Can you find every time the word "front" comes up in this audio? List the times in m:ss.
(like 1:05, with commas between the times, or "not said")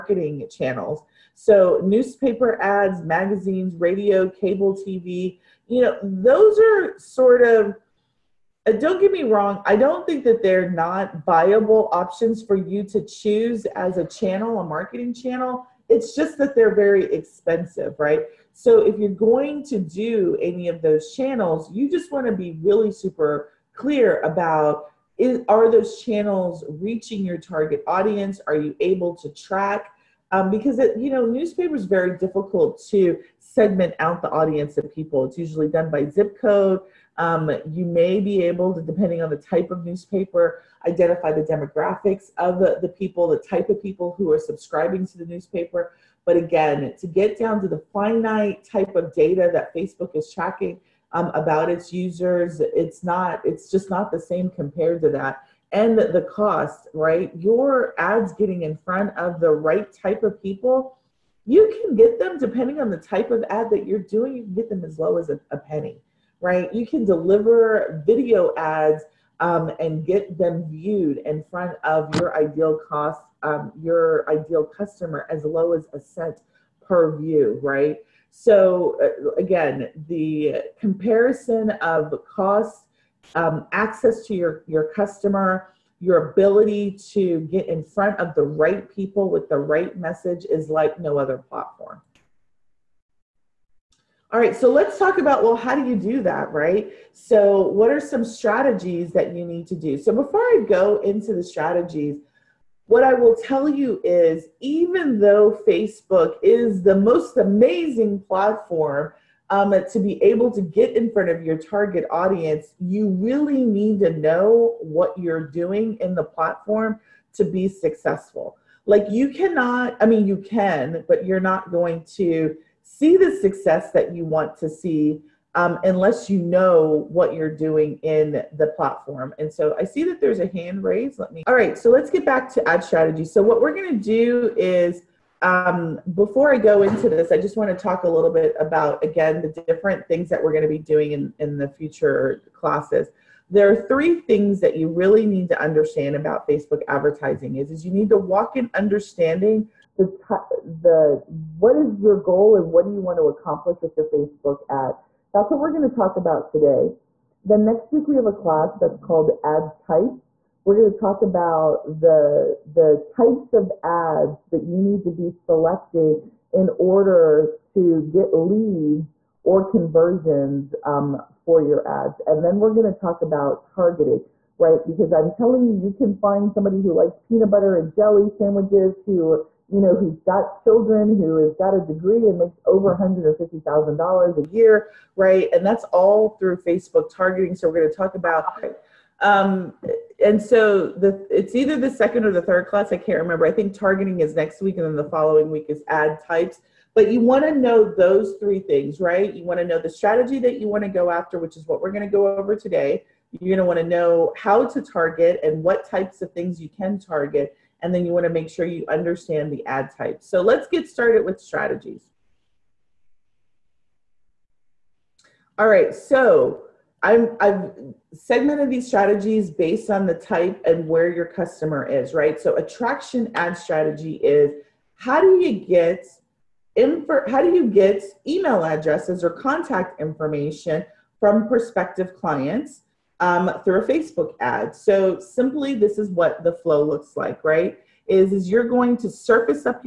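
0:58, 1:11, 1:27, 1:51.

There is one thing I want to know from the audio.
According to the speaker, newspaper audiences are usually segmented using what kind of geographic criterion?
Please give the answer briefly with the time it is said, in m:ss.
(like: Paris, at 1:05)
zip code, at 0:36.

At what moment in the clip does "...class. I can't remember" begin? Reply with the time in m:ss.
3:12.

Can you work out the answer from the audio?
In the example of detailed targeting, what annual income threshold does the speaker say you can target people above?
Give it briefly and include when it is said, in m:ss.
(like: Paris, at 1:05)
$150,000, at 3:02.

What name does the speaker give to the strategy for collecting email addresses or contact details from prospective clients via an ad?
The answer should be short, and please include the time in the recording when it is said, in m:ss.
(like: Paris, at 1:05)
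attraction ad strategy, at 3:42.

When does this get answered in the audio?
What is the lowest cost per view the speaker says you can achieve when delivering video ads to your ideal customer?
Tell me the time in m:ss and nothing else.
1:15.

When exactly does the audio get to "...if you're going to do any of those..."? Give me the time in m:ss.
0:18.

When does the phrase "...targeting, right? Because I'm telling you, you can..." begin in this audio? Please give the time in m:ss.
2:53.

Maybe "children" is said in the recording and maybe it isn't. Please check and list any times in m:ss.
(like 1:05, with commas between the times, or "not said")
3:00.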